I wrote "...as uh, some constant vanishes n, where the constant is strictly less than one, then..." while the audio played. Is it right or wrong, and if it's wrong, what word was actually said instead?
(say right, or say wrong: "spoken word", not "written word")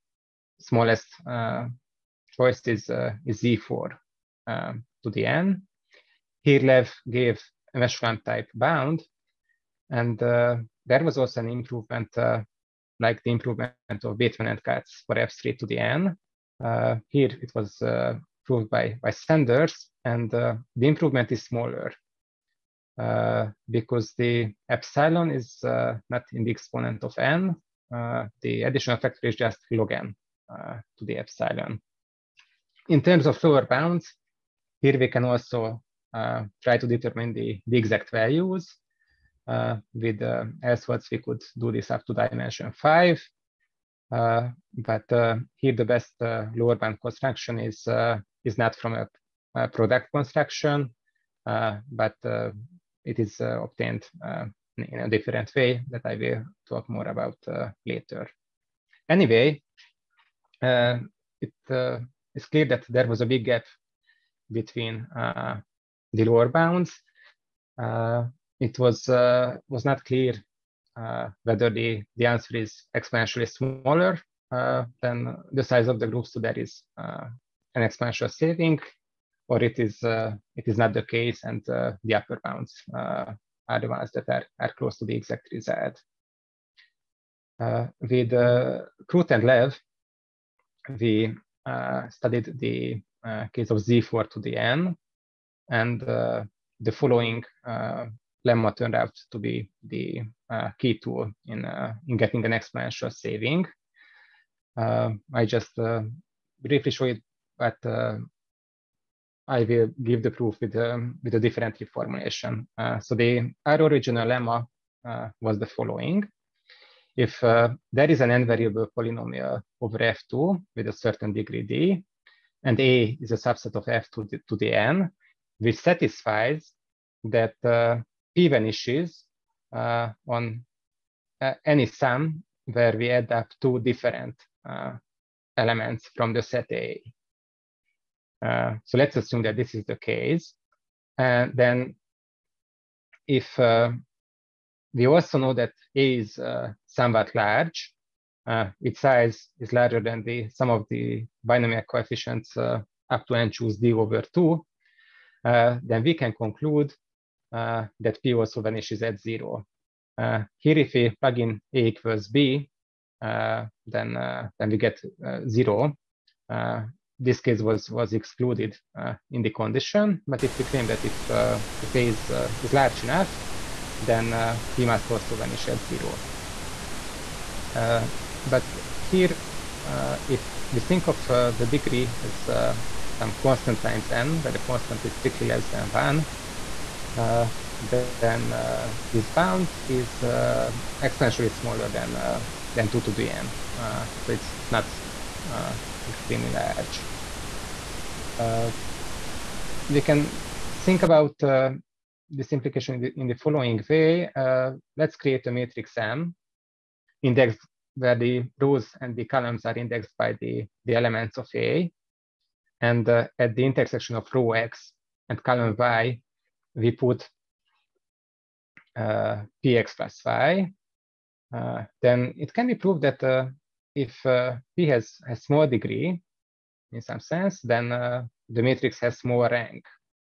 wrong: "times", not "vanishes".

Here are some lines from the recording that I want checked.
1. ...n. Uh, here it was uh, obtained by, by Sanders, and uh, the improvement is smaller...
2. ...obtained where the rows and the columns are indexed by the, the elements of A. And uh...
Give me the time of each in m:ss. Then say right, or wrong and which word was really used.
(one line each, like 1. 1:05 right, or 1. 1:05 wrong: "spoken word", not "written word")
1. 0:15 wrong: "proved", not "obtained"
2. 3:27 wrong: "indexed", not "obtained".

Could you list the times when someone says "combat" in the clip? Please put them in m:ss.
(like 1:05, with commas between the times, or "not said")
not said.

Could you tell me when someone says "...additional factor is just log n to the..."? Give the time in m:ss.
0:28.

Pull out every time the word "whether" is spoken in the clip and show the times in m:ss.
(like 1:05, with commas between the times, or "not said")
1:11.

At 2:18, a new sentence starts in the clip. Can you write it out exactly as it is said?
Uh, so let's assume that this is the case.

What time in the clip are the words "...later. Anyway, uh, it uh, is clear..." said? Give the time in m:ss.
0:57.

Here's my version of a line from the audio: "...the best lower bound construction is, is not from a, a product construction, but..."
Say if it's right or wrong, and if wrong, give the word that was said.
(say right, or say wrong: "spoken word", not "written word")
right.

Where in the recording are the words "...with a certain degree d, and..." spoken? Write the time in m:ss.
2:00.